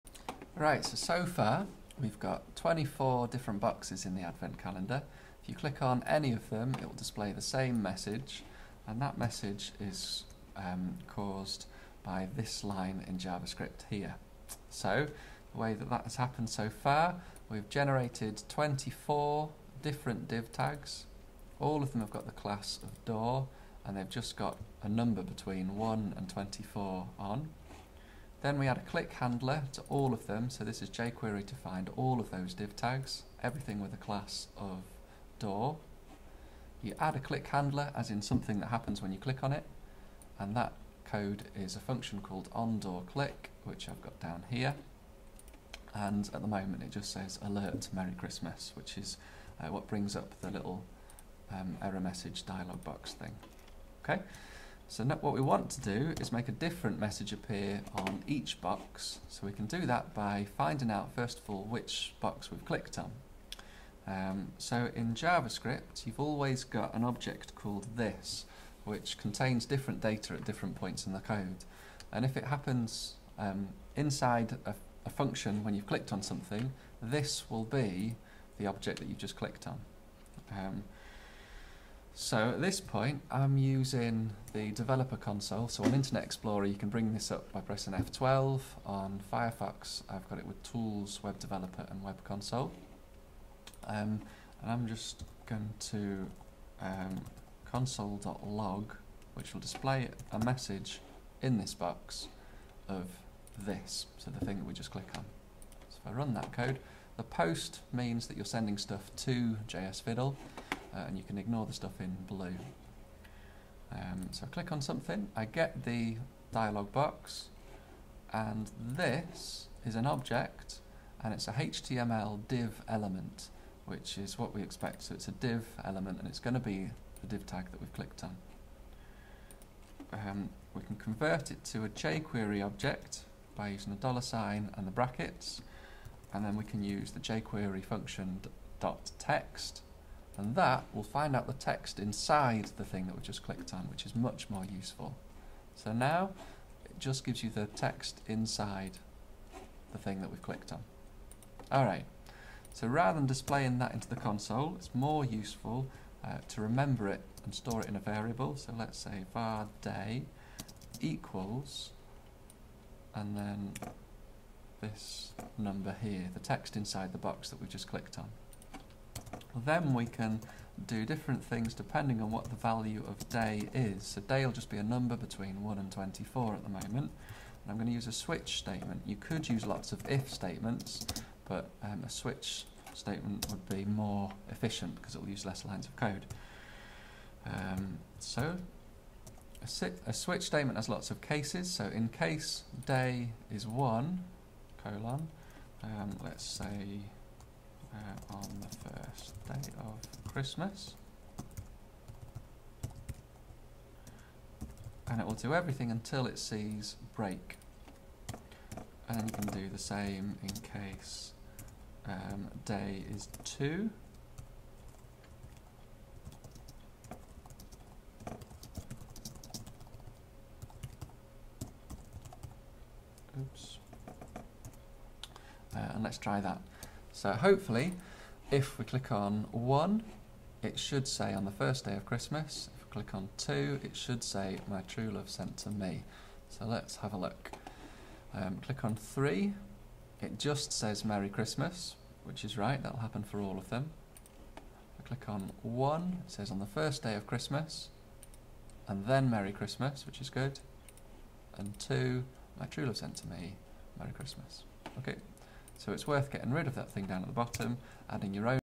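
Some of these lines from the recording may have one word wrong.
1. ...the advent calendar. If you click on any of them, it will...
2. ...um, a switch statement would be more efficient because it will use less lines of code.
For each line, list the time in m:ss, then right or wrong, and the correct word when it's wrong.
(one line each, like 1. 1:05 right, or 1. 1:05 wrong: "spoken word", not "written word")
1. 0:04 right
2. 3:01 right.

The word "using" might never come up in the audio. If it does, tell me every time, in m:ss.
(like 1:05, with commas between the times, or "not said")
1:23, 2:13.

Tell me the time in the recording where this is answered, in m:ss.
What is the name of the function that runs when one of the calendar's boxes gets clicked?
0:42.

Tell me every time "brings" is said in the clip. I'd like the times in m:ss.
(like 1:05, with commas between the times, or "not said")
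0:49, 1:26.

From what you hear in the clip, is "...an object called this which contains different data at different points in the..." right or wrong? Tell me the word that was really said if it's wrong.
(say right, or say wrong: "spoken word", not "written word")
right.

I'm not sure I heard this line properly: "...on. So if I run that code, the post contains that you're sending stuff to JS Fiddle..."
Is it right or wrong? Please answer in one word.
wrong.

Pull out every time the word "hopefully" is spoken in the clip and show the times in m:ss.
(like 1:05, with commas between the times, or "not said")
3:47.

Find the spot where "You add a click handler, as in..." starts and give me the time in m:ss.
0:36.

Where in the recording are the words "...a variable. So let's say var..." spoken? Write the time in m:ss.
2:37.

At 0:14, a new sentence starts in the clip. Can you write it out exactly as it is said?
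So, the way that that has happened so far, we've generated 24 different div tags.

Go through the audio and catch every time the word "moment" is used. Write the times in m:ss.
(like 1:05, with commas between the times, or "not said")
0:46, 2:56.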